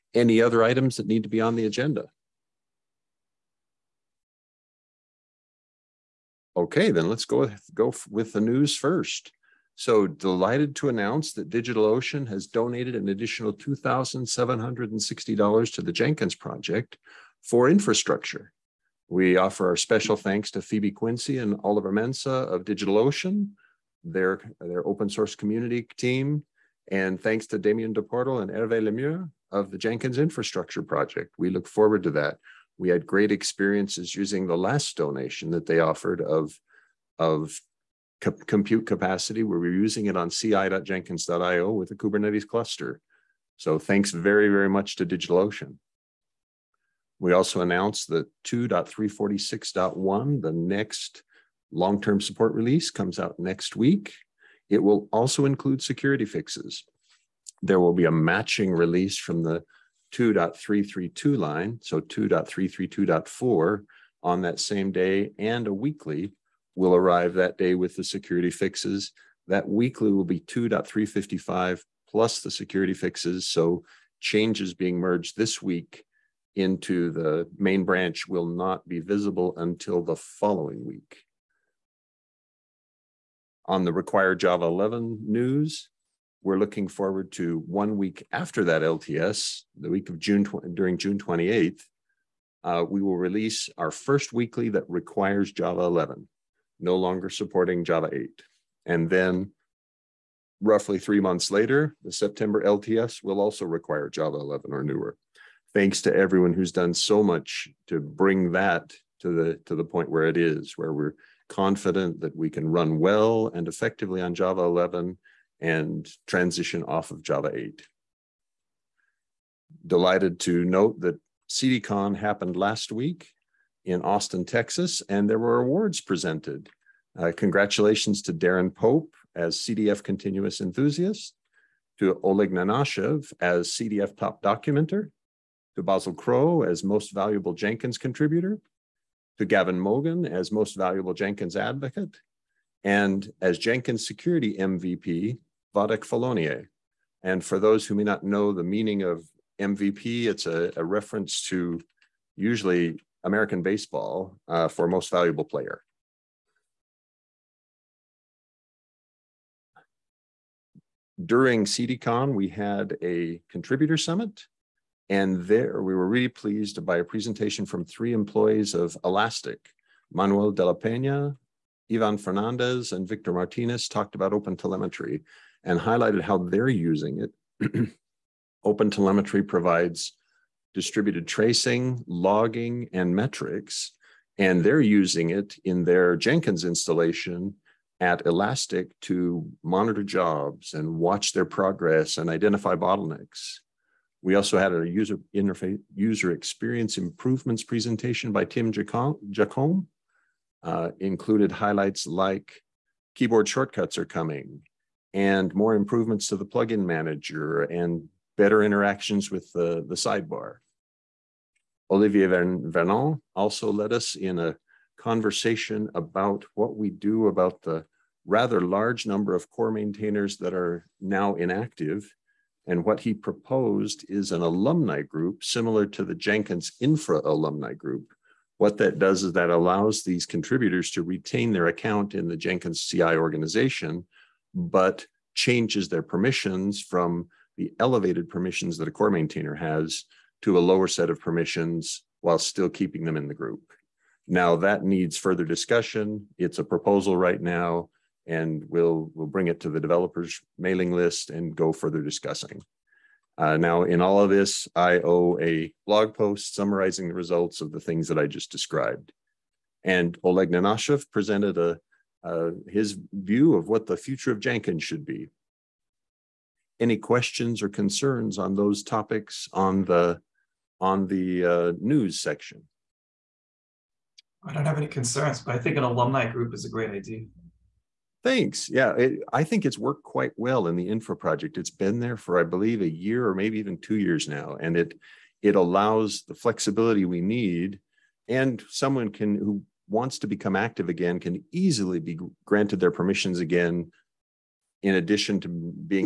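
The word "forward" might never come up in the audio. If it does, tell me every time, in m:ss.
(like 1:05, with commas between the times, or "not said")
0:31, 1:26.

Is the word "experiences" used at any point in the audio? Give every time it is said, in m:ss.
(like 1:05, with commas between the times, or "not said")
0:33, 3:16.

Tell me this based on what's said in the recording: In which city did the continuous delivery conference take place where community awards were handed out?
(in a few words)
Austin, Texas.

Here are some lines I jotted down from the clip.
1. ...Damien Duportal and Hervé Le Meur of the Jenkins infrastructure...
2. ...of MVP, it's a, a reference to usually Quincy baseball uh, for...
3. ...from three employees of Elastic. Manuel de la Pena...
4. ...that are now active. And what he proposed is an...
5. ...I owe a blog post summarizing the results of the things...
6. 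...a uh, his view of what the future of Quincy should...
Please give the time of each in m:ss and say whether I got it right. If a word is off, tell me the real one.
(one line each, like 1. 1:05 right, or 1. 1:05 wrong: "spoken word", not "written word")
1. 0:27 right
2. 2:29 wrong: "American", not "Quincy"
3. 2:47 right
4. 3:40 wrong: "inactive", not "active"
5. 4:14 right
6. 4:21 wrong: "Jenkins", not "Quincy".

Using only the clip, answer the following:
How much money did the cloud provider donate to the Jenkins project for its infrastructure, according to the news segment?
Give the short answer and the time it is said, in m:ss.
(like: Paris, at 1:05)
$2,760, at 0:13.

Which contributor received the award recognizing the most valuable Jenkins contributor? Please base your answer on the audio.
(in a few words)
Basil Crow.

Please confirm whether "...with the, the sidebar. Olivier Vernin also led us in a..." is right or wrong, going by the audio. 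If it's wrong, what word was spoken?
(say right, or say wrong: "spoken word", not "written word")
right.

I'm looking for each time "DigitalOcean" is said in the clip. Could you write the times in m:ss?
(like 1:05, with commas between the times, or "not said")
0:11, 0:22, 0:45.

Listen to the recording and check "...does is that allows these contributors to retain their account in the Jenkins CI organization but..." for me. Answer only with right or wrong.
right.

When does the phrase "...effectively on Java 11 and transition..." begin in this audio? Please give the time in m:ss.
1:53.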